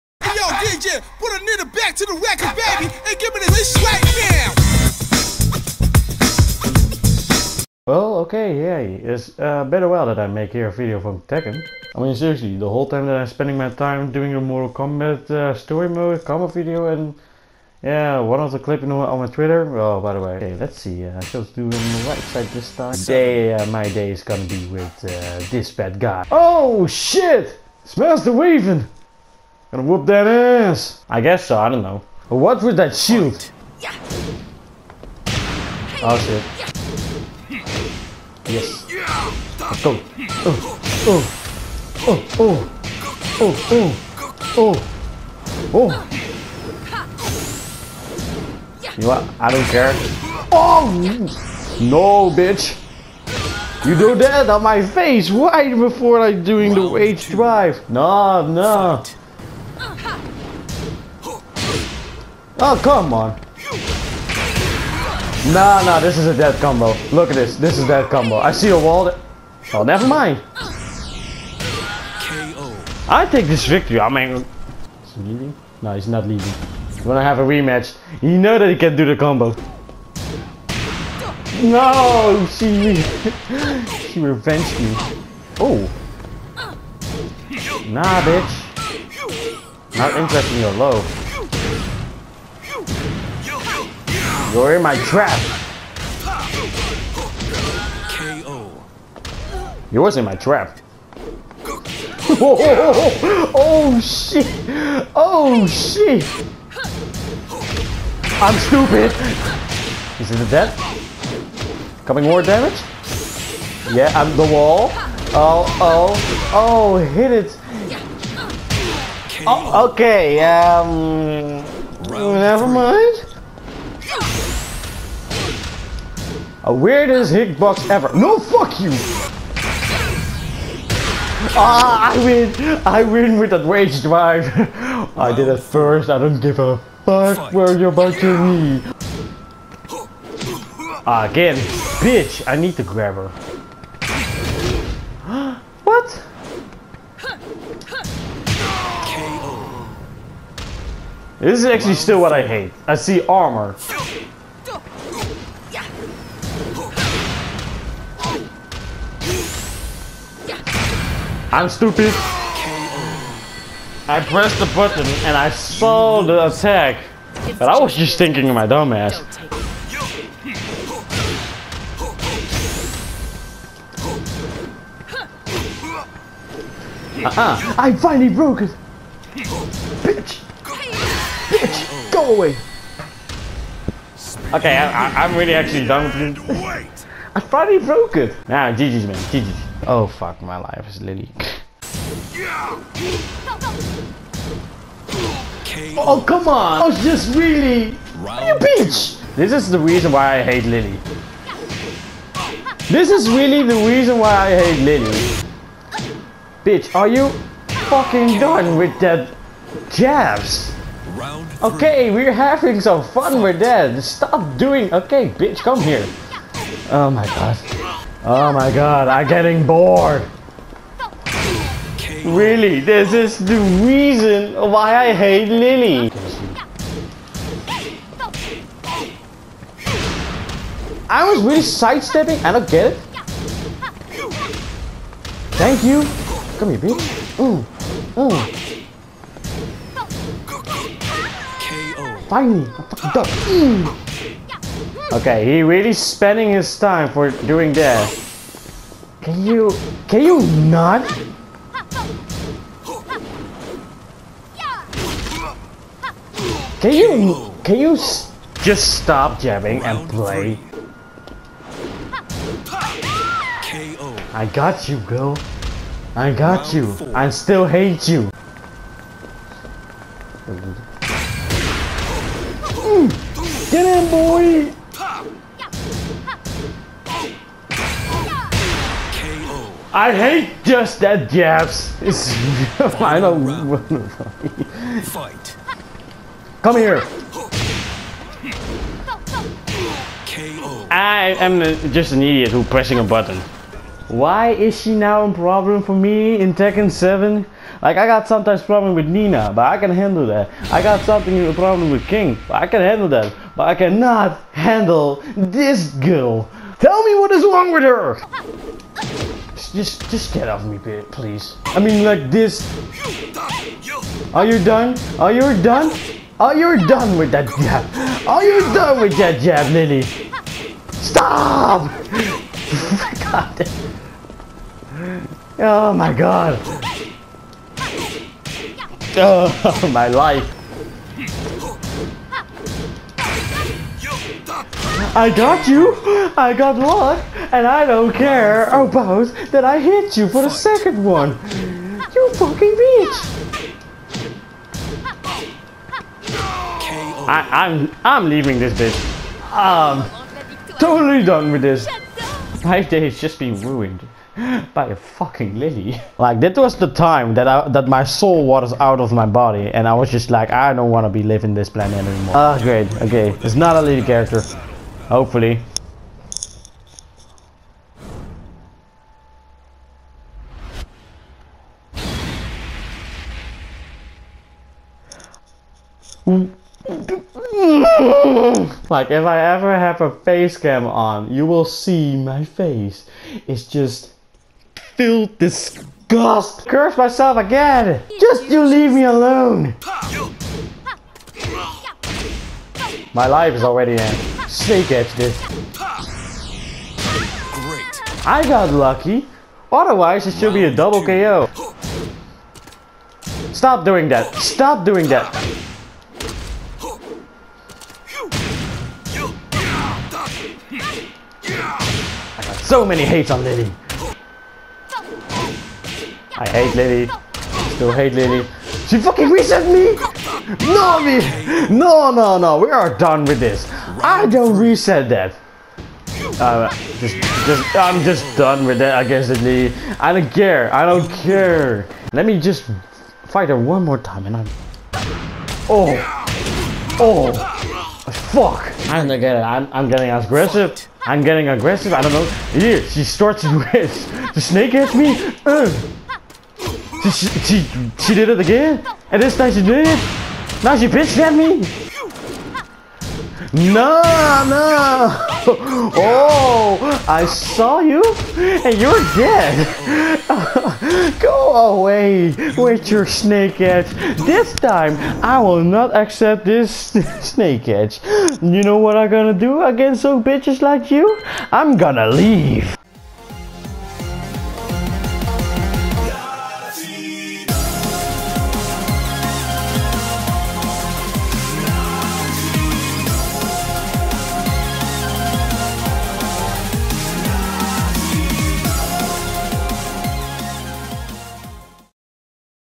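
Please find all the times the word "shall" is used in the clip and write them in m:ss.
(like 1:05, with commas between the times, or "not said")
0:21.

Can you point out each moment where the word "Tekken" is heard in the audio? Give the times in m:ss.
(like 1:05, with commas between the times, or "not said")
0:11, 4:56.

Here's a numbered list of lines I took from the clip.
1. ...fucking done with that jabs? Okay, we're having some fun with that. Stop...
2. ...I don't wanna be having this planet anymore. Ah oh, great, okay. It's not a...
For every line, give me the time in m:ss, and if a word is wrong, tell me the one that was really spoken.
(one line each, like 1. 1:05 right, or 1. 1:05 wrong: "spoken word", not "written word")
1. 3:27 right
2. 6:00 wrong: "living", not "having".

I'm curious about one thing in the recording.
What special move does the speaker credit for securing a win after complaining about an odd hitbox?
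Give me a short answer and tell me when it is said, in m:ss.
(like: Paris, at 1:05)
rage drive, at 2:13.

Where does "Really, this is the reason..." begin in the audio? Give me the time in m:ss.
3:42.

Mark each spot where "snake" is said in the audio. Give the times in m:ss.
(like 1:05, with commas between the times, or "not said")
6:34, 7:24, 7:43, 7:47.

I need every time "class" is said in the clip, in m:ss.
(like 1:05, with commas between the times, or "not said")
not said.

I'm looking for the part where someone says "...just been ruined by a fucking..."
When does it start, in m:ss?
5:53.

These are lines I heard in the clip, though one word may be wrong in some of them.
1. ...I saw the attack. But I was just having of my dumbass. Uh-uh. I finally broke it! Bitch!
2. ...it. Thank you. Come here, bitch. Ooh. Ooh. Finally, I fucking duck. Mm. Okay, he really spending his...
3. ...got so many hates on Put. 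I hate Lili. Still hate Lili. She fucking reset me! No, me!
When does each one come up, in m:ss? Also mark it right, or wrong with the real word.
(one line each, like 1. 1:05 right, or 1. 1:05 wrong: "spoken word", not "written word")
1. 2:45 wrong: "thinking", not "having"
2. 3:52 right
3. 6:52 wrong: "Lili", not "Put".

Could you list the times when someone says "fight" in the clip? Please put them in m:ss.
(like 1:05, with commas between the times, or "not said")
4:45, 7:13.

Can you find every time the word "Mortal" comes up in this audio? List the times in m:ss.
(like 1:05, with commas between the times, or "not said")
0:14.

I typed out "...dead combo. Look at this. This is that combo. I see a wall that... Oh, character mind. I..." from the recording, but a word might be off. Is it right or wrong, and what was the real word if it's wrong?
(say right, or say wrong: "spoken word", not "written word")
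wrong: "never", not "character".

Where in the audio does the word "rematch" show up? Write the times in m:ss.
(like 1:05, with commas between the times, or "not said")
1:17.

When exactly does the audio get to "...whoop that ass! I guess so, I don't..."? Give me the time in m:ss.
0:29.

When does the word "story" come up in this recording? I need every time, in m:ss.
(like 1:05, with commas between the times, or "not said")
0:15.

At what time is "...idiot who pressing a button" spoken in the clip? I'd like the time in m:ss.
4:52.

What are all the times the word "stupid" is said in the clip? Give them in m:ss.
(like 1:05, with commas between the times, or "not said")
1:48, 2:41.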